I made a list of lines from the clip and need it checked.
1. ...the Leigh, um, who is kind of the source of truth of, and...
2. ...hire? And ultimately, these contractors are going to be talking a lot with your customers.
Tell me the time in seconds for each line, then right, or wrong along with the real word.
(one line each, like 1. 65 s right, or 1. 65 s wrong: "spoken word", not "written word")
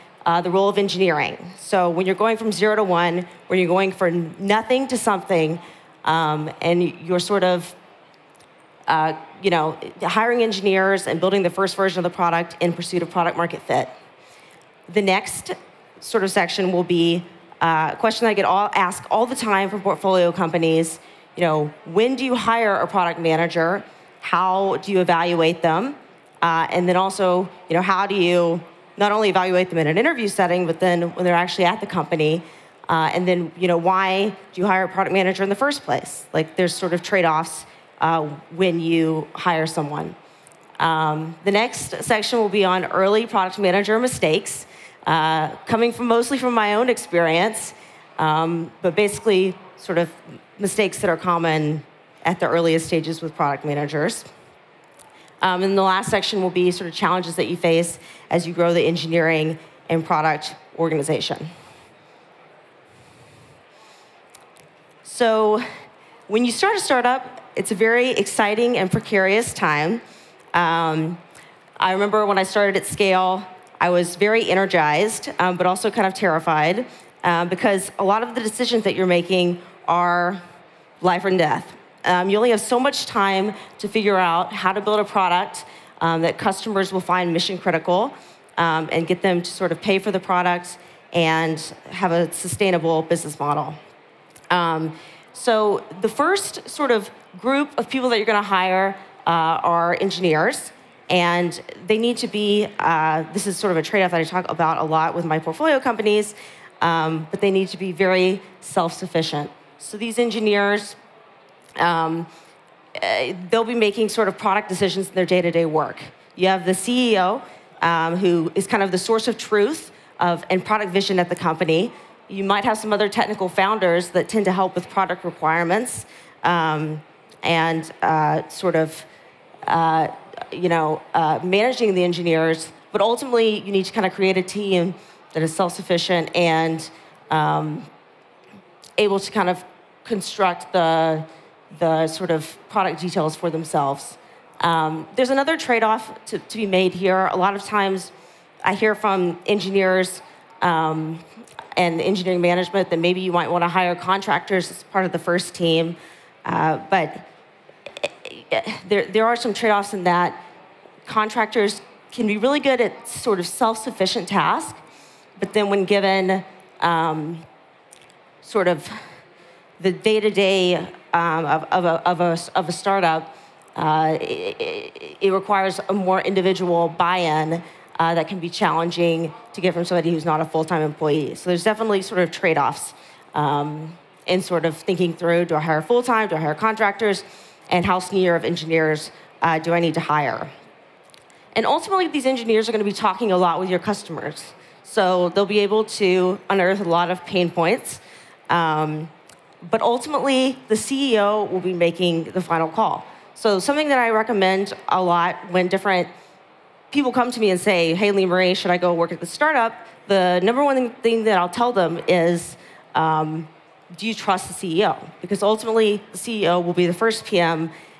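1. 116 s wrong: "CEO", not "Leigh"
2. 189 s wrong: "engineers", not "contractors".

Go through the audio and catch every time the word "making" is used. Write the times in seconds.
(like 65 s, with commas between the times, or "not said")
79 s, 113 s, 201 s.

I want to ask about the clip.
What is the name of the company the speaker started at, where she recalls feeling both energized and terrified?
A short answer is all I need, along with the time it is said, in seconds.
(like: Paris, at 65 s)
Scale, at 72 s.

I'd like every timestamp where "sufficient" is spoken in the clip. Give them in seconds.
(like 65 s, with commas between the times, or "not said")
108 s, 135 s, 163 s.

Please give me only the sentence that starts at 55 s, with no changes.
Um, and the last section will be sort of challenges that you face as you grow the engineering and product organization.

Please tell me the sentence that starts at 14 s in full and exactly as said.
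The next sort of section will be uh, a question that I get all asked all the time from portfolio companies.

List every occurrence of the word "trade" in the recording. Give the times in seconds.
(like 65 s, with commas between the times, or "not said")
37 s, 103 s, 145 s, 159 s, 182 s.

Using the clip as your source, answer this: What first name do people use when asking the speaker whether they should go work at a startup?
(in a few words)
Leigh Marie.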